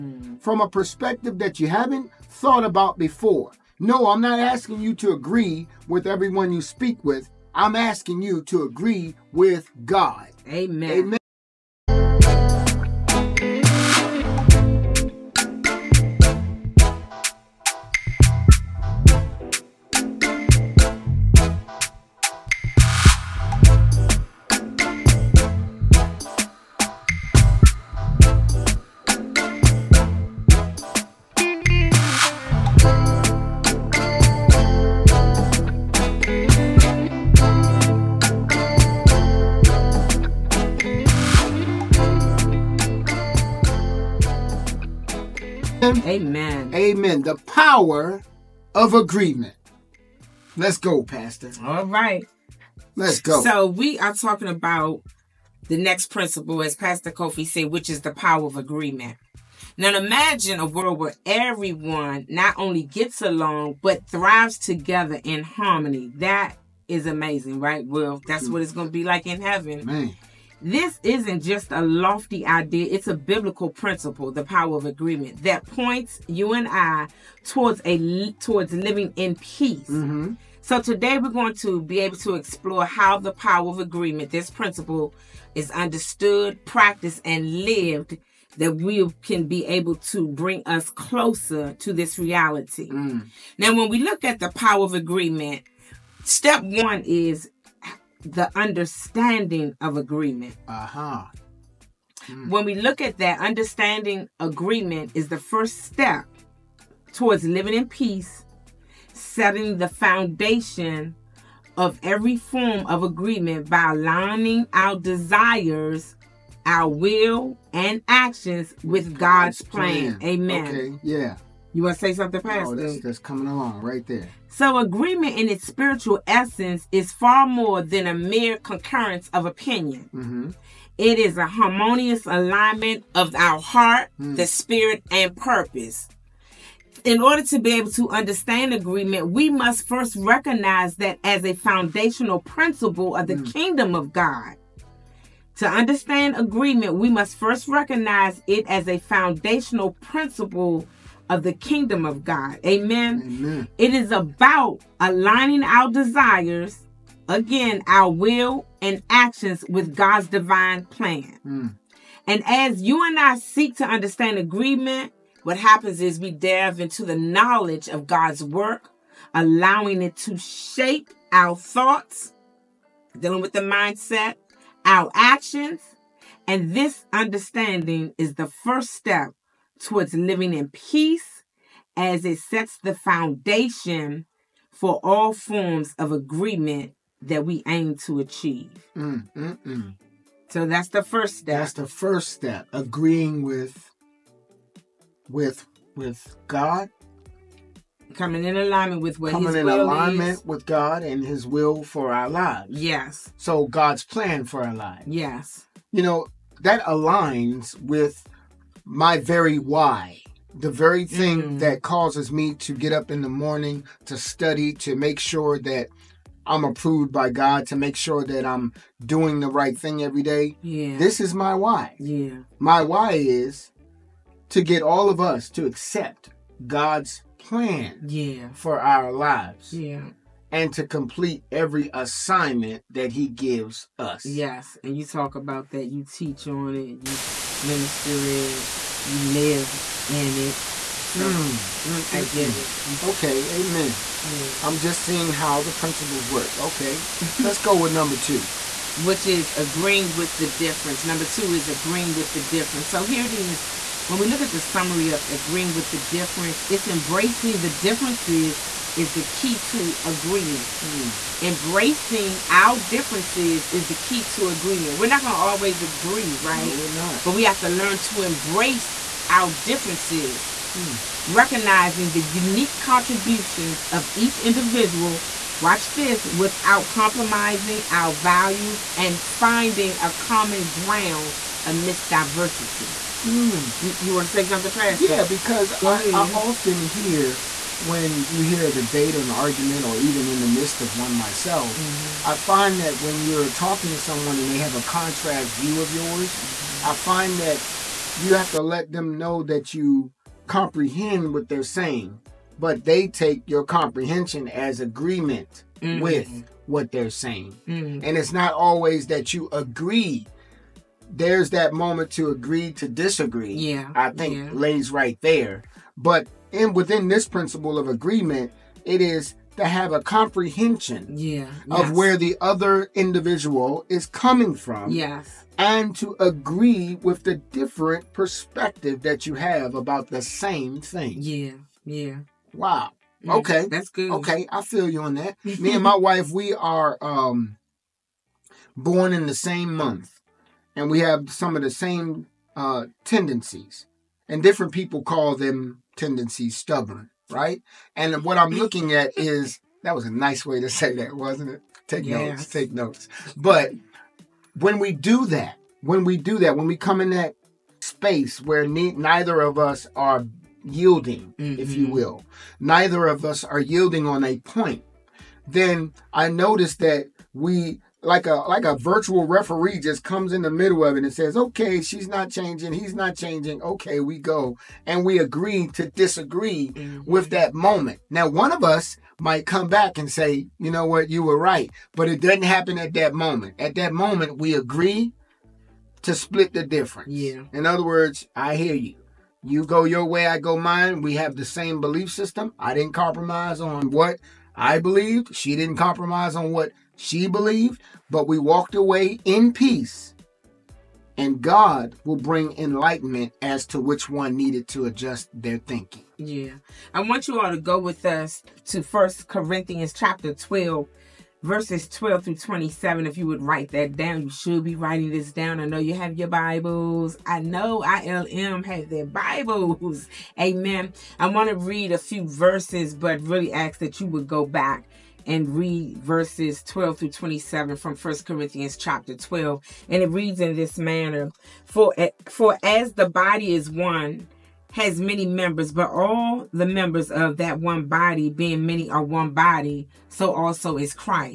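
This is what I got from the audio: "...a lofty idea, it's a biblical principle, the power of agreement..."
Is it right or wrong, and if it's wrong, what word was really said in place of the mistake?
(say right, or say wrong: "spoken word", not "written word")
right.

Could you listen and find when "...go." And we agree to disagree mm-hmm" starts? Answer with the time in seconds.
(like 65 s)
374 s.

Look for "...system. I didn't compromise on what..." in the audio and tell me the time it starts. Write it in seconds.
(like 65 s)
392 s.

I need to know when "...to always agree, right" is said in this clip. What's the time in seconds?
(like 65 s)
265 s.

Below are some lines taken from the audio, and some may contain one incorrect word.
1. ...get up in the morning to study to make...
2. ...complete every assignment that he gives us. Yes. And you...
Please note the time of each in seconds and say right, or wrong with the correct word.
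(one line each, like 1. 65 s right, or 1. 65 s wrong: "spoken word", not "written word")
1. 212 s right
2. 230 s right.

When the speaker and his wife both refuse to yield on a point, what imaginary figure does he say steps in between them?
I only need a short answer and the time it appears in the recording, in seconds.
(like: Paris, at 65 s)
A virtual referee, at 368 s.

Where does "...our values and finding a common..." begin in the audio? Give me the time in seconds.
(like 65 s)
277 s.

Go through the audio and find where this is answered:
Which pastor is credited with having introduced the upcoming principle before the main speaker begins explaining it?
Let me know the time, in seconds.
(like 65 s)
56 s.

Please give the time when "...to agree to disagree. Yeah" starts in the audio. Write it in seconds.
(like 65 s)
312 s.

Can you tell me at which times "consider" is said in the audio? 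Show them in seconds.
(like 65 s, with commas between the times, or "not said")
not said.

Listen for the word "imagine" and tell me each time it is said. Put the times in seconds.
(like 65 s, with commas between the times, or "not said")
59 s.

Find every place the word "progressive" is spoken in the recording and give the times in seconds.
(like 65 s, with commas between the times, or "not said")
not said.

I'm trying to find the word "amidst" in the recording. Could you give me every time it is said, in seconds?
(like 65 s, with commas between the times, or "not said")
281 s.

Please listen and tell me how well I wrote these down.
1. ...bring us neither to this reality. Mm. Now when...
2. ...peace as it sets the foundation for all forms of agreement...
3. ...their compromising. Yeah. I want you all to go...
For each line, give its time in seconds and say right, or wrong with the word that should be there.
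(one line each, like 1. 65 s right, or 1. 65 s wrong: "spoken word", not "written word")
1. 90 s wrong: "closer", not "neither"
2. 180 s right
3. 405 s wrong: "thinking", not "compromising".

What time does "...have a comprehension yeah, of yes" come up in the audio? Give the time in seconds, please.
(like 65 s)
319 s.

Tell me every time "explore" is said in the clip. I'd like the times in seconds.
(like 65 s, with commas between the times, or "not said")
82 s.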